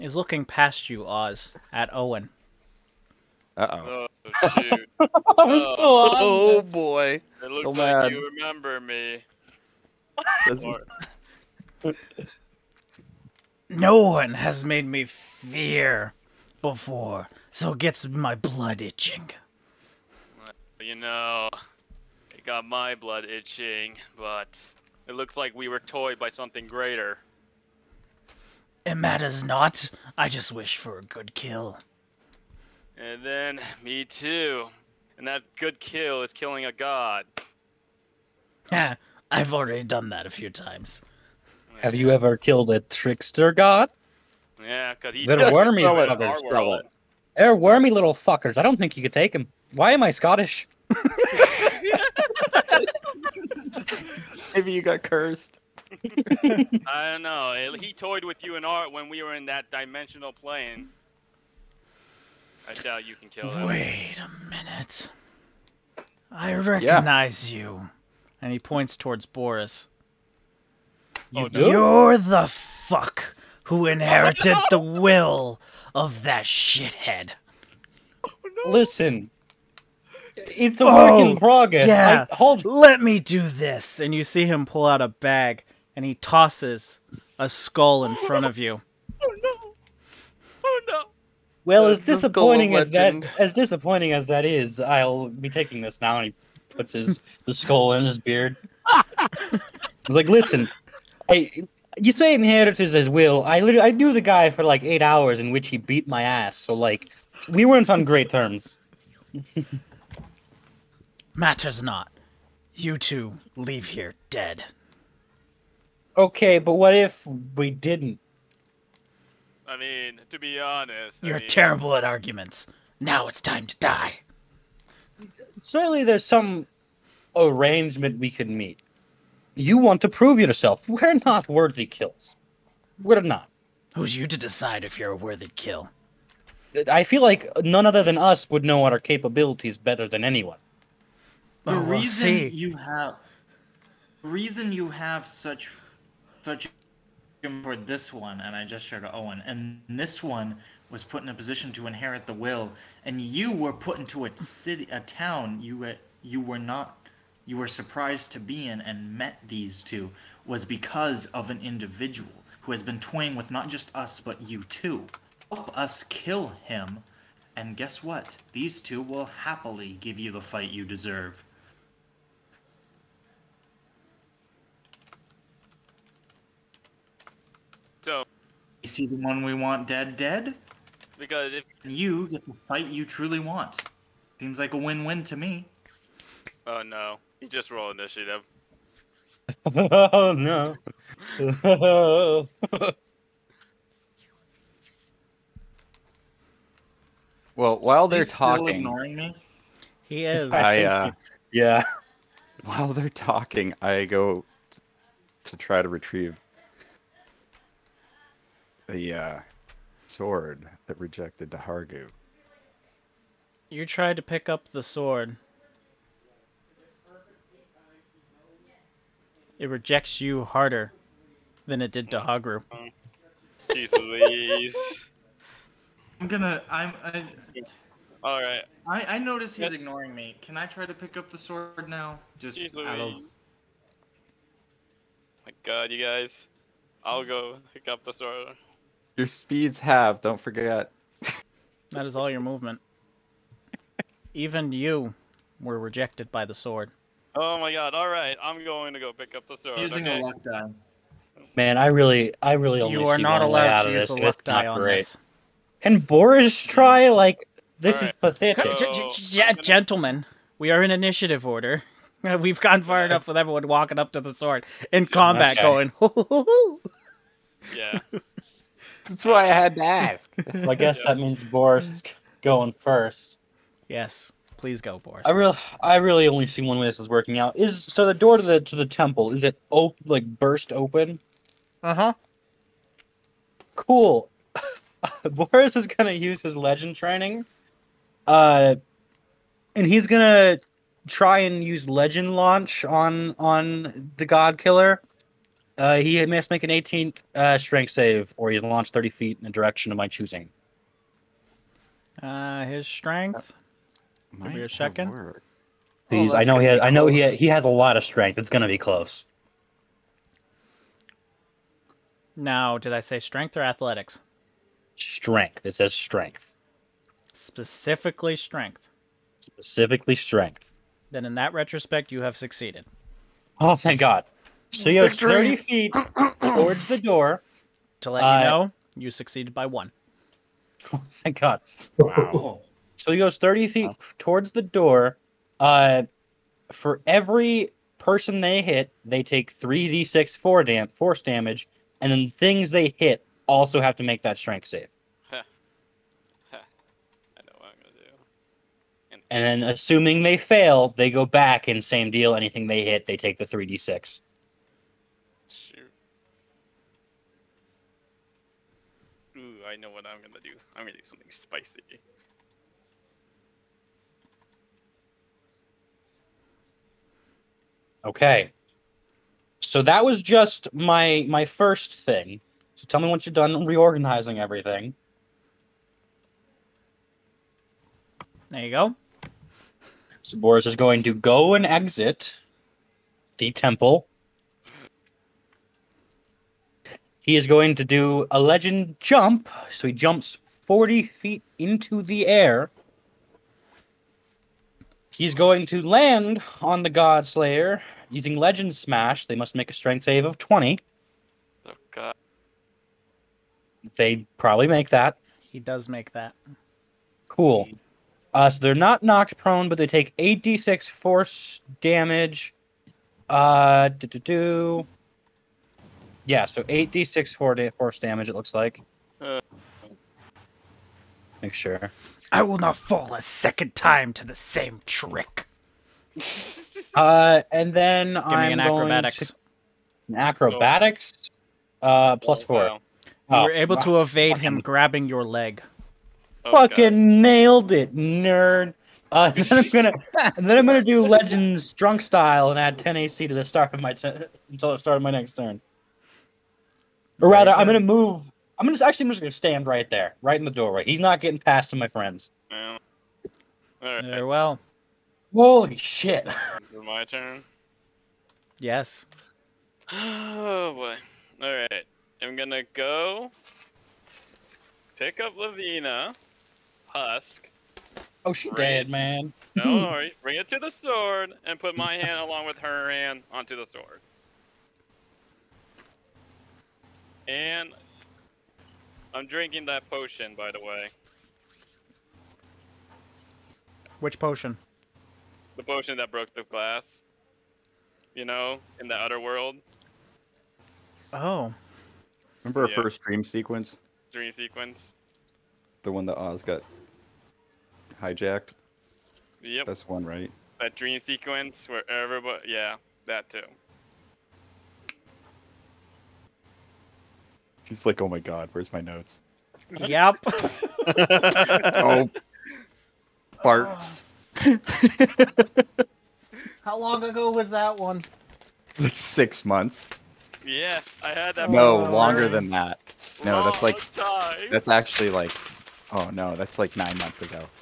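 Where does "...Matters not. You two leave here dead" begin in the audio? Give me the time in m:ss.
1:51.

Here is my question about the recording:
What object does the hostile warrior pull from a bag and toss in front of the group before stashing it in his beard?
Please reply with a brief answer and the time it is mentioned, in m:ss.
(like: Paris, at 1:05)
A skull, at 1:27.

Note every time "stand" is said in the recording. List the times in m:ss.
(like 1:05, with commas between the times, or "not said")
7:29.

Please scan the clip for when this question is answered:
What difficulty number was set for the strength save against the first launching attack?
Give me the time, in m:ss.
4:56.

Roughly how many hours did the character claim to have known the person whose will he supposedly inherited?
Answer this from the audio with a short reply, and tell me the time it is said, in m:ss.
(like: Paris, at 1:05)
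8, at 1:44.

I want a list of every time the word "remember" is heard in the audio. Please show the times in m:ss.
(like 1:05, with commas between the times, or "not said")
0:08, 8:12.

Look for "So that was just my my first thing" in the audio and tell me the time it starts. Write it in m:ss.
6:09.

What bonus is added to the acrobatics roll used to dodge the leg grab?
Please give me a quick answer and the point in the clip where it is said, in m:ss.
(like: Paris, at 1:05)
+4, at 7:12.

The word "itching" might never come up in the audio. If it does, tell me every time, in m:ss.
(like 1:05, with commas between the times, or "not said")
0:18, 0:23.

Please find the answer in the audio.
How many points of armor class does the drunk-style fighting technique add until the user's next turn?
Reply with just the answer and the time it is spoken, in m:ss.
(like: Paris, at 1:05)
10, at 7:22.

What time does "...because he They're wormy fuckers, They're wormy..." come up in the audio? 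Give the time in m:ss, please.
0:44.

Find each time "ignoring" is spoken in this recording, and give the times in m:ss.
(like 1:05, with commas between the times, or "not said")
3:18, 3:49.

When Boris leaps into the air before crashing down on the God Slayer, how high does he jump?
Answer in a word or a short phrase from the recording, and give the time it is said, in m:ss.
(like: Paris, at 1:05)
40 feet, at 6:30.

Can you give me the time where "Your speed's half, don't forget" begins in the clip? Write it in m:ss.
3:59.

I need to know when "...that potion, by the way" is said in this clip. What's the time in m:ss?
7:59.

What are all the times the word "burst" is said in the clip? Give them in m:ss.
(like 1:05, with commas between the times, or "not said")
4:40.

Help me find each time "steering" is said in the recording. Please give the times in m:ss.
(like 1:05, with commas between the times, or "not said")
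not said.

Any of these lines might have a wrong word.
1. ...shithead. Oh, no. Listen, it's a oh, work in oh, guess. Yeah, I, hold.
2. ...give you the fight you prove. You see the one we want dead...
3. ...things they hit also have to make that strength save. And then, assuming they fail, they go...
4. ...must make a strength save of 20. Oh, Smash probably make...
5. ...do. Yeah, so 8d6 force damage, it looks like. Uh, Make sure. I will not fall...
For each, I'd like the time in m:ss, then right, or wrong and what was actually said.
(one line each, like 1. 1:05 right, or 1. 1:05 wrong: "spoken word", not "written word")
1. 1:16 wrong: "progress", not "guess"
2. 2:49 wrong: "deserve", not "prove"
3. 5:42 right
4. 6:39 wrong: "They", not "Smash"
5. 6:54 right.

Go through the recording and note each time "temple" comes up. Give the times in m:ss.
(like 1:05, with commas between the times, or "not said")
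4:38, 6:23.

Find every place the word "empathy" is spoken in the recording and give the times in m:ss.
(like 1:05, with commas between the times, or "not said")
not said.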